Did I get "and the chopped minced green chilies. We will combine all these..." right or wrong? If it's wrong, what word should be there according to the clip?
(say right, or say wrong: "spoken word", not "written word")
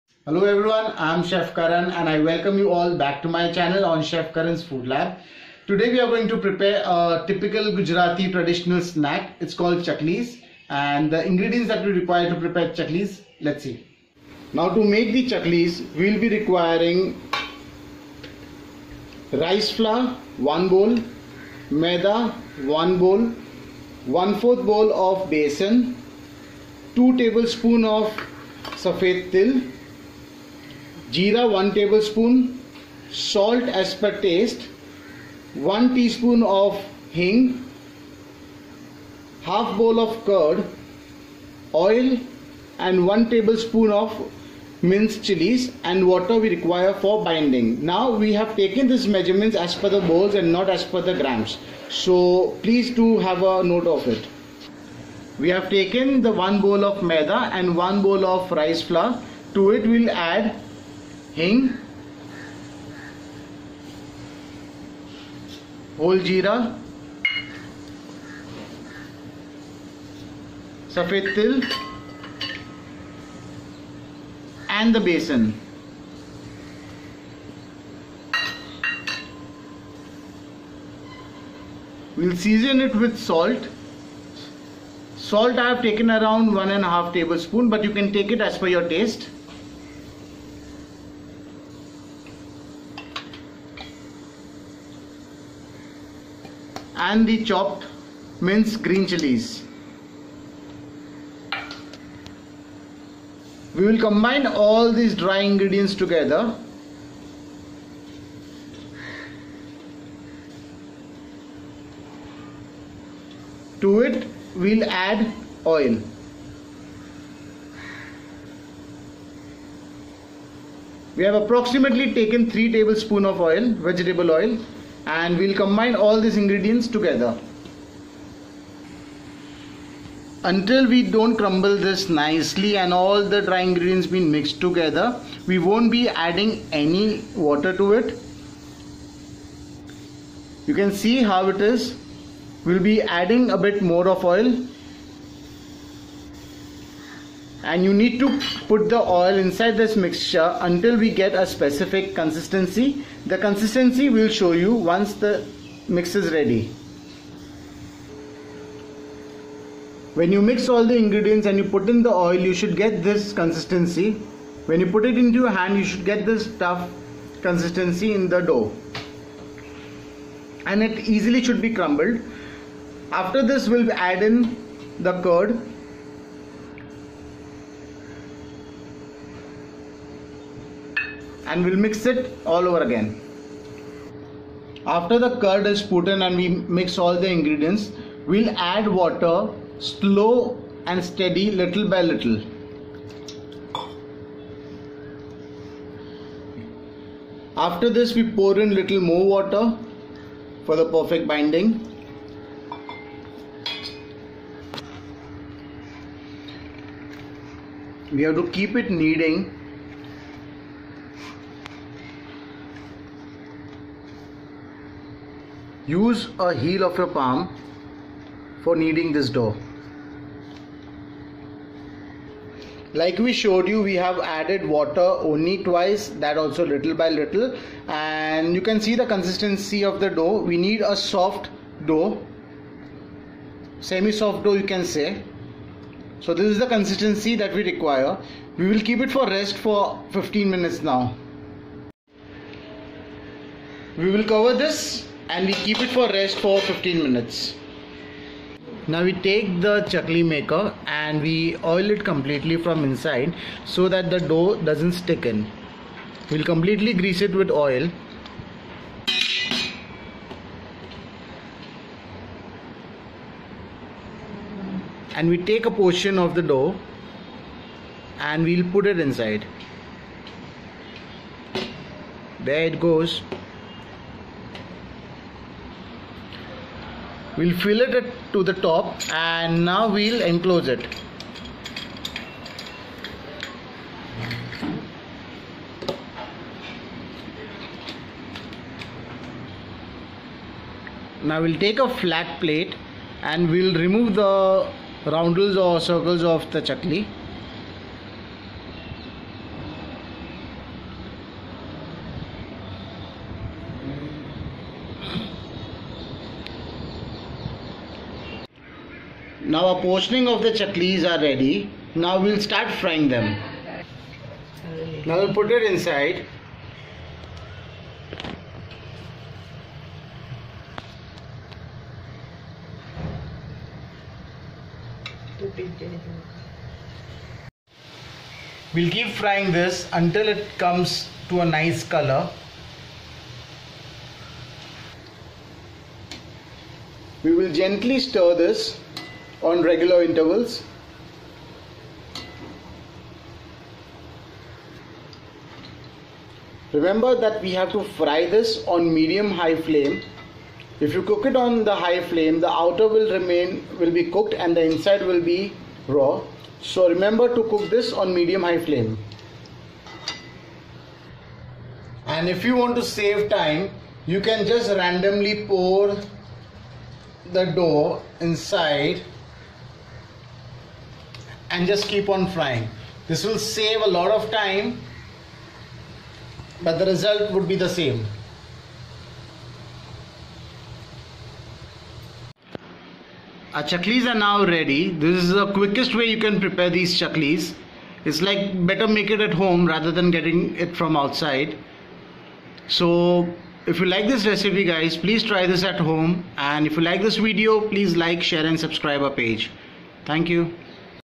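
right.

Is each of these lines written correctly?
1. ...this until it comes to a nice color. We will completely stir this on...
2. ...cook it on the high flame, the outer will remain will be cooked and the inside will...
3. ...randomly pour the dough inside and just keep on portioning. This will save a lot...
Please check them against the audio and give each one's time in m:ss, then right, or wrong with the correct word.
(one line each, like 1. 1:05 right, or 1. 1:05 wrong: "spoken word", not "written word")
1. 5:29 wrong: "gently", not "completely"
2. 5:51 right
3. 6:04 wrong: "frying", not "portioning".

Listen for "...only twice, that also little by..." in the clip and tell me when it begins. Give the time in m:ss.
3:45.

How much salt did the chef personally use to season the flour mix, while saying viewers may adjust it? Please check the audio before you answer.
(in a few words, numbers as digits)
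1.5 tablespoons.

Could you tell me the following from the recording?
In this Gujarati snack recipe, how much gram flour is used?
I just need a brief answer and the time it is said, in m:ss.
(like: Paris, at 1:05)
1/4 bowl, at 0:24.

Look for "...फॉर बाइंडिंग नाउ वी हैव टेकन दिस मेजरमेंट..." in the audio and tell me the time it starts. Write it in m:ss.
0:47.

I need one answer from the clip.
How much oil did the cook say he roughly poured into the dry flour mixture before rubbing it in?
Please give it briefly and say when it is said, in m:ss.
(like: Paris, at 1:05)
3 tablespoons, at 2:02.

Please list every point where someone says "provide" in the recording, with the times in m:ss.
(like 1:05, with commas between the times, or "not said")
not said.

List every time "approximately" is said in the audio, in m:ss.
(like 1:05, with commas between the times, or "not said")
2:01.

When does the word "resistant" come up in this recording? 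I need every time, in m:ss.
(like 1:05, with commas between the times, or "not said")
not said.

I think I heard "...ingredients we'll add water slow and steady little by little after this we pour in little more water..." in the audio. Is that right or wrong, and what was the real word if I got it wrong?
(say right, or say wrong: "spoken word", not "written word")
right.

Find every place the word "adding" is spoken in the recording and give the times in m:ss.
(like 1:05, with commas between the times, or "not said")
2:16, 2:23.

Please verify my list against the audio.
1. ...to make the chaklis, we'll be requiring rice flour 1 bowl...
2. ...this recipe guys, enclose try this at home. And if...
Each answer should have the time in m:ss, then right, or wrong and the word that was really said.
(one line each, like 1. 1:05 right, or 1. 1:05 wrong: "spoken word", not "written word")
1. 0:14 right
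2. 6:34 wrong: "please", not "enclose".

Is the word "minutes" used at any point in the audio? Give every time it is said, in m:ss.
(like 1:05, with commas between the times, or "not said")
4:00, 4:07.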